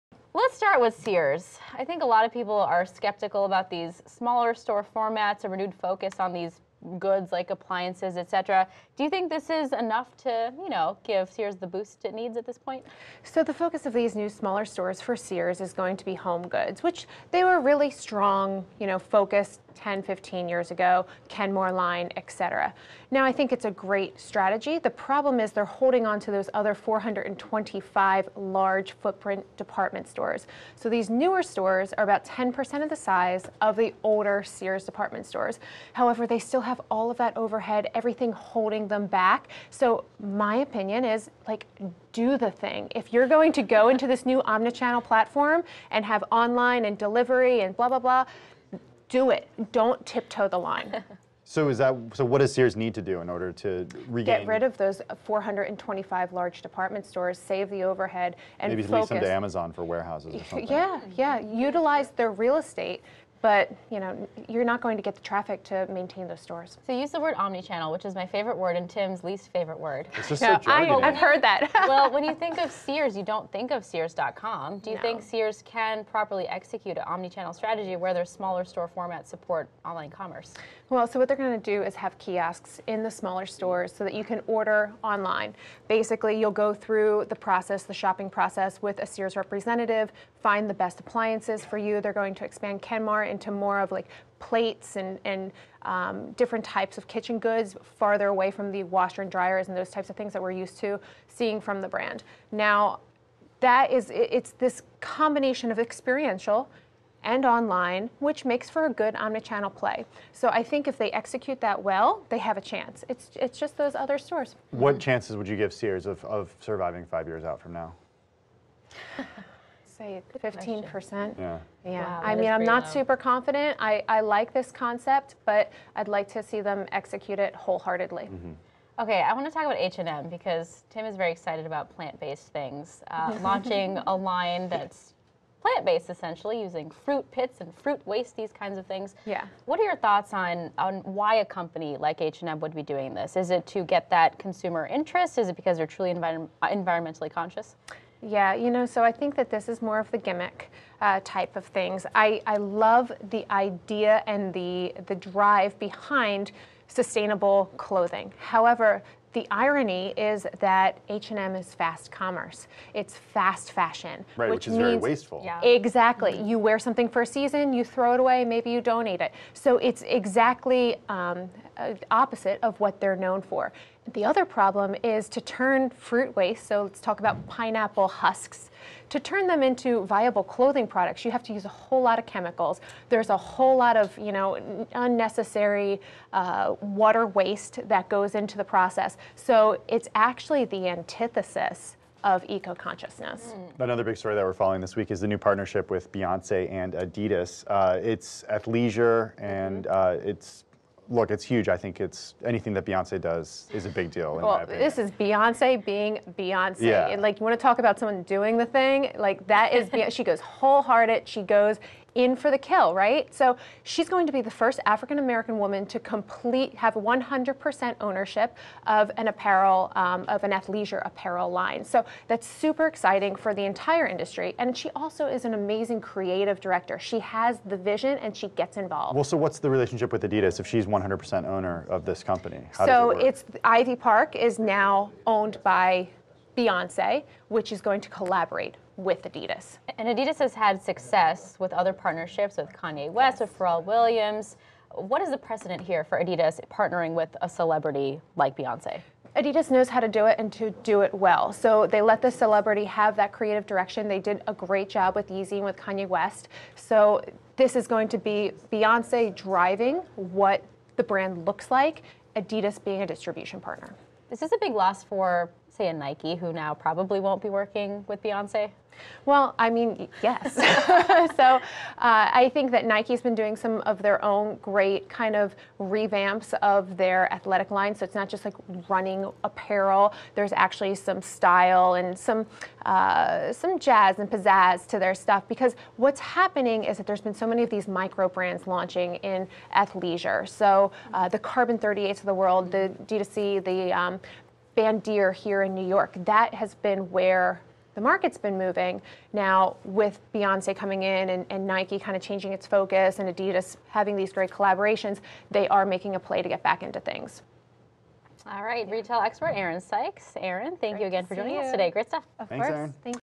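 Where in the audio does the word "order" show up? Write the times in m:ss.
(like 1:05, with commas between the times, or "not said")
0:53, 1:24.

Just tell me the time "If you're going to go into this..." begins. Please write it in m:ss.
0:42.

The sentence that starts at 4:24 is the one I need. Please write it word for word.
This is a big loss for, say, a Nike, who now probably won't be working with Beyonce.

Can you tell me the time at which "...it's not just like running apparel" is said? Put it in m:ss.
4:38.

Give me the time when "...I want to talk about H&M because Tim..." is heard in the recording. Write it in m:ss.
2:09.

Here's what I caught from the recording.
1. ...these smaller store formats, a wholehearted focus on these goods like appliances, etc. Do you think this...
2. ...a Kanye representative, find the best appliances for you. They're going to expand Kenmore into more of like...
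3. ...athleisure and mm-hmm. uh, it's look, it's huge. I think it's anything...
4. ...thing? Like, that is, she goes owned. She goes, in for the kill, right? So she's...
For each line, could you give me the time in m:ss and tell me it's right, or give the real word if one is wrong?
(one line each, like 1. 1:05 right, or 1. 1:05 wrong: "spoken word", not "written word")
1. 0:03 wrong: "renewed", not "wholehearted"
2. 1:28 wrong: "Sears", not "Kanye"
3. 3:18 right
4. 3:28 wrong: "wholehearted", not "owned".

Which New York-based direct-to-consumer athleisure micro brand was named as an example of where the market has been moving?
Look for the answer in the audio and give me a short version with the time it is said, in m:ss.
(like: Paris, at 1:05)
Bandier, at 4:54.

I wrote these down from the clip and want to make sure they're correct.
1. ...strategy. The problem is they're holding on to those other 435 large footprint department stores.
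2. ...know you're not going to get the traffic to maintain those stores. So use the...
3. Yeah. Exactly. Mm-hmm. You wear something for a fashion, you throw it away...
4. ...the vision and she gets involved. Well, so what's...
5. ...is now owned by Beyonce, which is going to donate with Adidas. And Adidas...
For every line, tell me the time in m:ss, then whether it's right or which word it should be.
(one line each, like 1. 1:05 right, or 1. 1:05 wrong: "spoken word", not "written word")
1. 0:24 wrong: "425", not "435"
2. 1:03 right
3. 2:45 wrong: "season", not "fashion"
4. 3:47 right
5. 3:54 wrong: "collaborate", not "donate".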